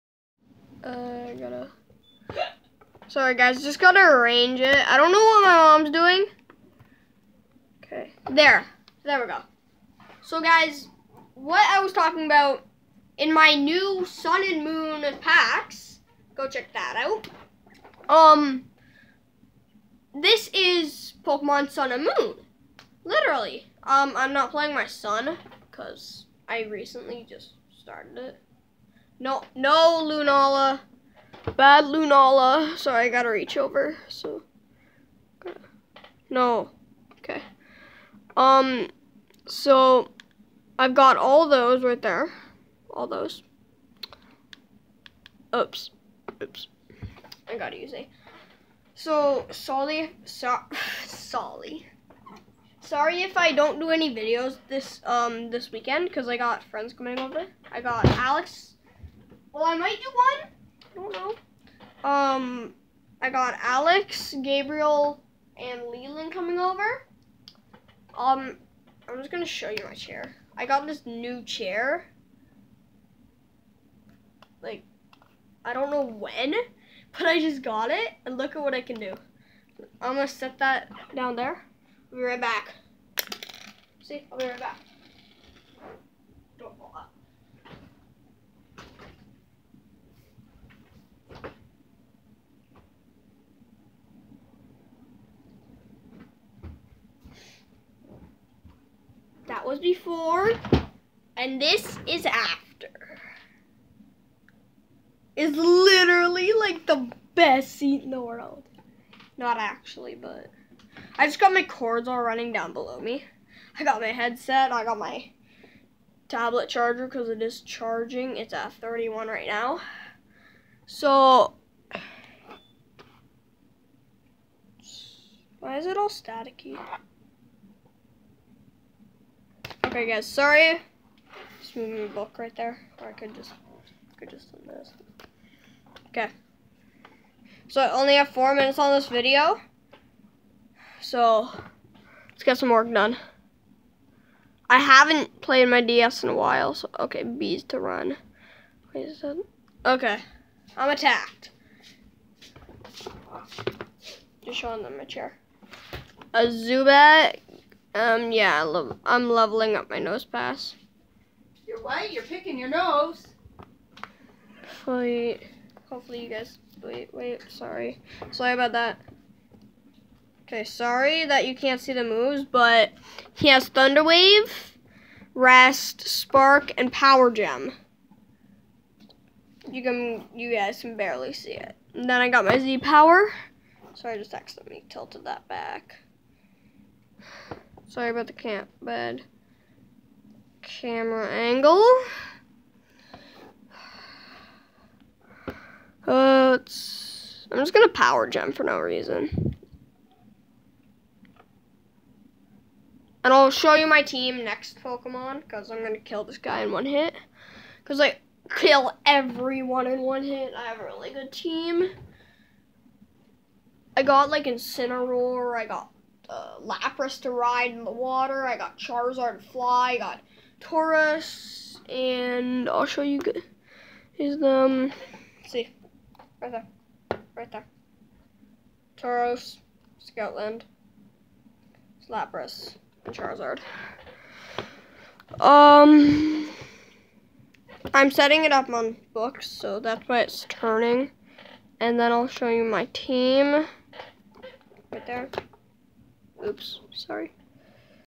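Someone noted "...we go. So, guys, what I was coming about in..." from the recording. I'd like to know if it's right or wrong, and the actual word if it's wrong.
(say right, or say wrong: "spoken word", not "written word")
wrong: "talking", not "coming".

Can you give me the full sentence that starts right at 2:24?
I haven't played my DS in a while, so okay, Bees to run.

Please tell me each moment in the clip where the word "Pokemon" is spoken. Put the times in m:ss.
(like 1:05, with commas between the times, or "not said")
0:21, 3:24.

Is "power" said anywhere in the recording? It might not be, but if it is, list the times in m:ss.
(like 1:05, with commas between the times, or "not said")
2:56, 3:02, 3:17.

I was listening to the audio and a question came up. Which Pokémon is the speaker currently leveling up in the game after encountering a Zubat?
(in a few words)
Nosepass.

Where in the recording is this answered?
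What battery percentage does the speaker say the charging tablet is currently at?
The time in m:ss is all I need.
1:58.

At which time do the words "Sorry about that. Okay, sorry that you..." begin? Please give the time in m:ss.
2:48.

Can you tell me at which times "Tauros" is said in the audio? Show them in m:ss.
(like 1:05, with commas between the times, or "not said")
3:40, 3:48.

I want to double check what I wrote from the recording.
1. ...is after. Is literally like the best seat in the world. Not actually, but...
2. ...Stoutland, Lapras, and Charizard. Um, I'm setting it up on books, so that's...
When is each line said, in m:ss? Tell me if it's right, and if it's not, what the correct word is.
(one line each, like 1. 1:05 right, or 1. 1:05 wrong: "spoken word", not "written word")
1. 1:42 right
2. 3:50 right.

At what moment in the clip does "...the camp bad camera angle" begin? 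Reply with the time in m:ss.
3:08.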